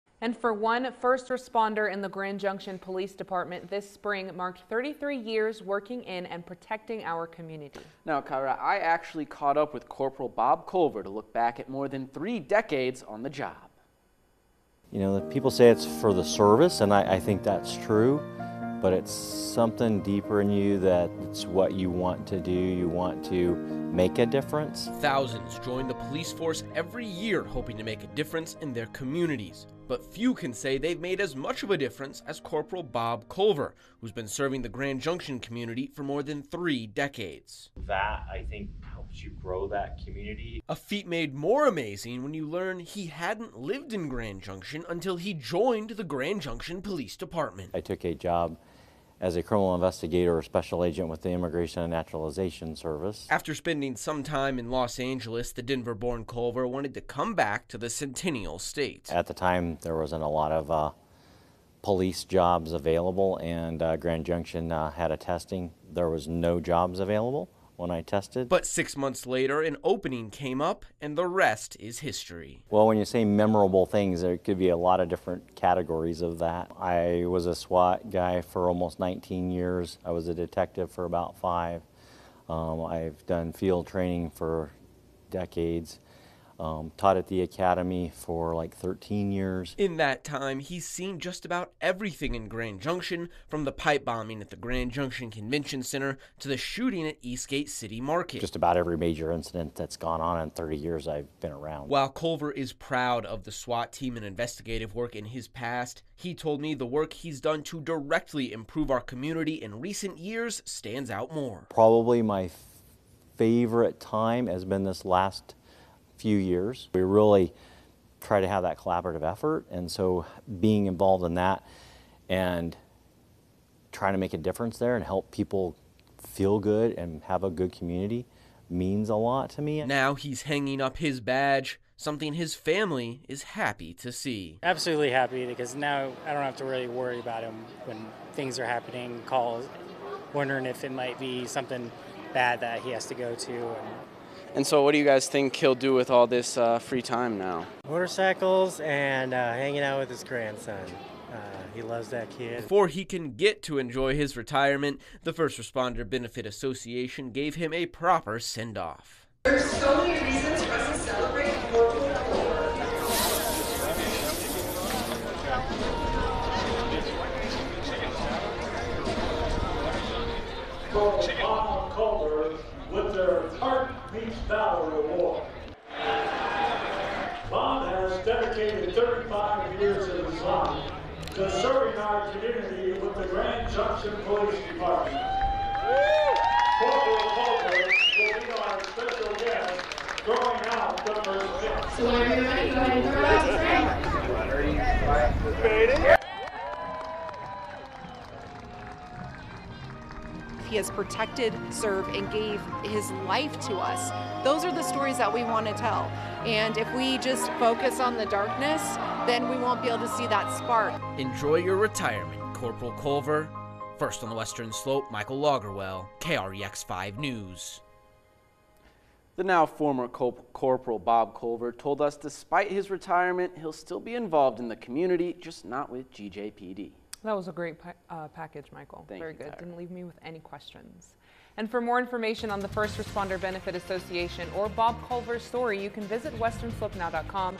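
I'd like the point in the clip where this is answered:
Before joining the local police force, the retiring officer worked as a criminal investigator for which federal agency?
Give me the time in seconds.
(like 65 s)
51 s.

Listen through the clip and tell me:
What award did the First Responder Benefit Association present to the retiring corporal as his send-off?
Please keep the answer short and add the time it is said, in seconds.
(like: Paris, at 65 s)
Heart Meets Valor Award, at 173 s.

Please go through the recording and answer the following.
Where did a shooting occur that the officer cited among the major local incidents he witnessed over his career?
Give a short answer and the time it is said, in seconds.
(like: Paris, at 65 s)
Eastgate City Market, at 97 s.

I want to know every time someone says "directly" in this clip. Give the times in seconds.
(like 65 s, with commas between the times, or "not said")
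107 s.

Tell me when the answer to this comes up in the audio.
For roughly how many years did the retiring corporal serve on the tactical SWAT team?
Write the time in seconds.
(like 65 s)
78 s.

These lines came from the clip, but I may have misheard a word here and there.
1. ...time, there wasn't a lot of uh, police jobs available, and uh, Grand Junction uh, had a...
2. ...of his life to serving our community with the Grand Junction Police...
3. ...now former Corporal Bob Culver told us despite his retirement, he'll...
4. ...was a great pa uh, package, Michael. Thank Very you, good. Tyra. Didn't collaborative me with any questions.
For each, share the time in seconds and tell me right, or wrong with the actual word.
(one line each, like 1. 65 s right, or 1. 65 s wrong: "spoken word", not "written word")
1. 59 s right
2. 180 s right
3. 219 s right
4. 227 s wrong: "leave", not "collaborative".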